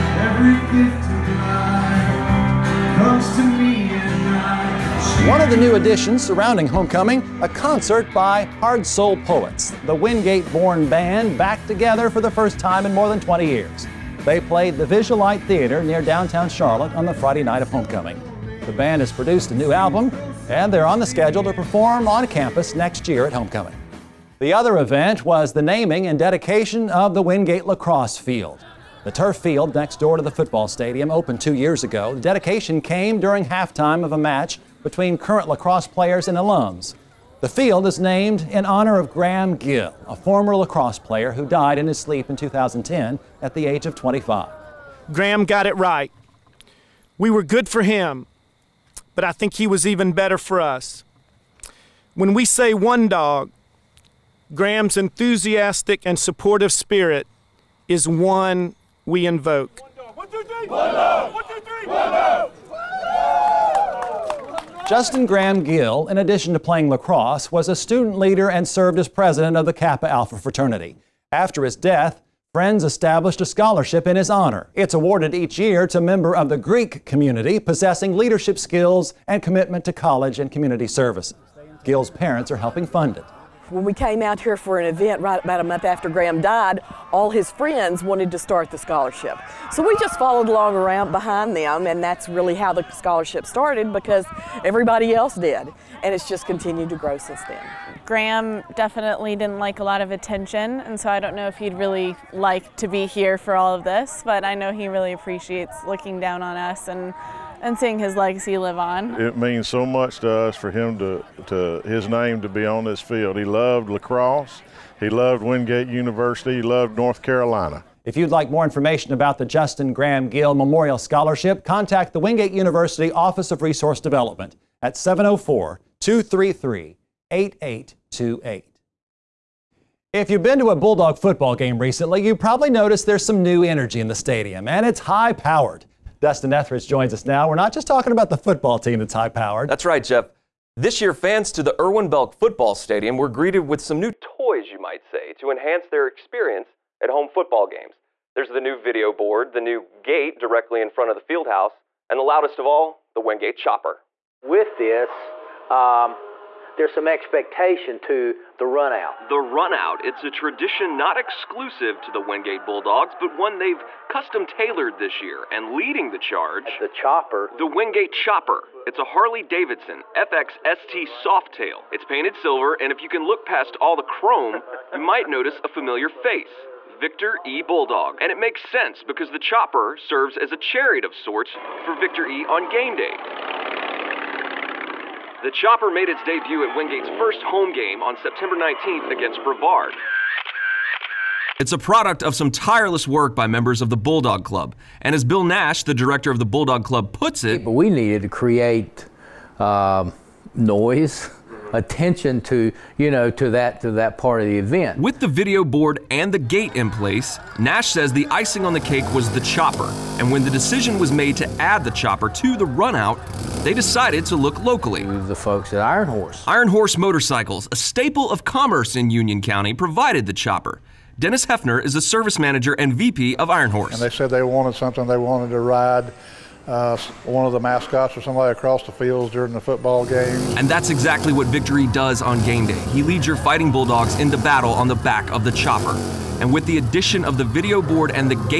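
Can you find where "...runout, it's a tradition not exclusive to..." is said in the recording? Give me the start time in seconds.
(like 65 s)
159 s.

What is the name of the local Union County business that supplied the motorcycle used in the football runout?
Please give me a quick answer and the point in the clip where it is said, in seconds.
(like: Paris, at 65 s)
Iron Horse Motorcycles, at 216 s.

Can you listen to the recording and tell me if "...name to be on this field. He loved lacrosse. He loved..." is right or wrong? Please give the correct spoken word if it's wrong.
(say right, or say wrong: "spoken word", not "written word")
right.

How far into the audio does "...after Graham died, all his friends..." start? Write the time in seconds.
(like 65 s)
85 s.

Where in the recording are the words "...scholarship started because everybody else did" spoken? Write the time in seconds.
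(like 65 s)
92 s.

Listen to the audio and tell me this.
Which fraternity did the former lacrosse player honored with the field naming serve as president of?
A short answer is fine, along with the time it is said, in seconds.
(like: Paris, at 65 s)
Kappa Alpha, at 69 s.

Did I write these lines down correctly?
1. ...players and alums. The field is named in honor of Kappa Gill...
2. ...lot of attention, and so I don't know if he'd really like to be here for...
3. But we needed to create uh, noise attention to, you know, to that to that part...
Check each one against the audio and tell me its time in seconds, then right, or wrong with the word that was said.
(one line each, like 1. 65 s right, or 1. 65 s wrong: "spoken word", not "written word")
1. 35 s wrong: "Graham", not "Kappa"
2. 99 s right
3. 197 s right.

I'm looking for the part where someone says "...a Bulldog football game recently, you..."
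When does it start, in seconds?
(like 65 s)
130 s.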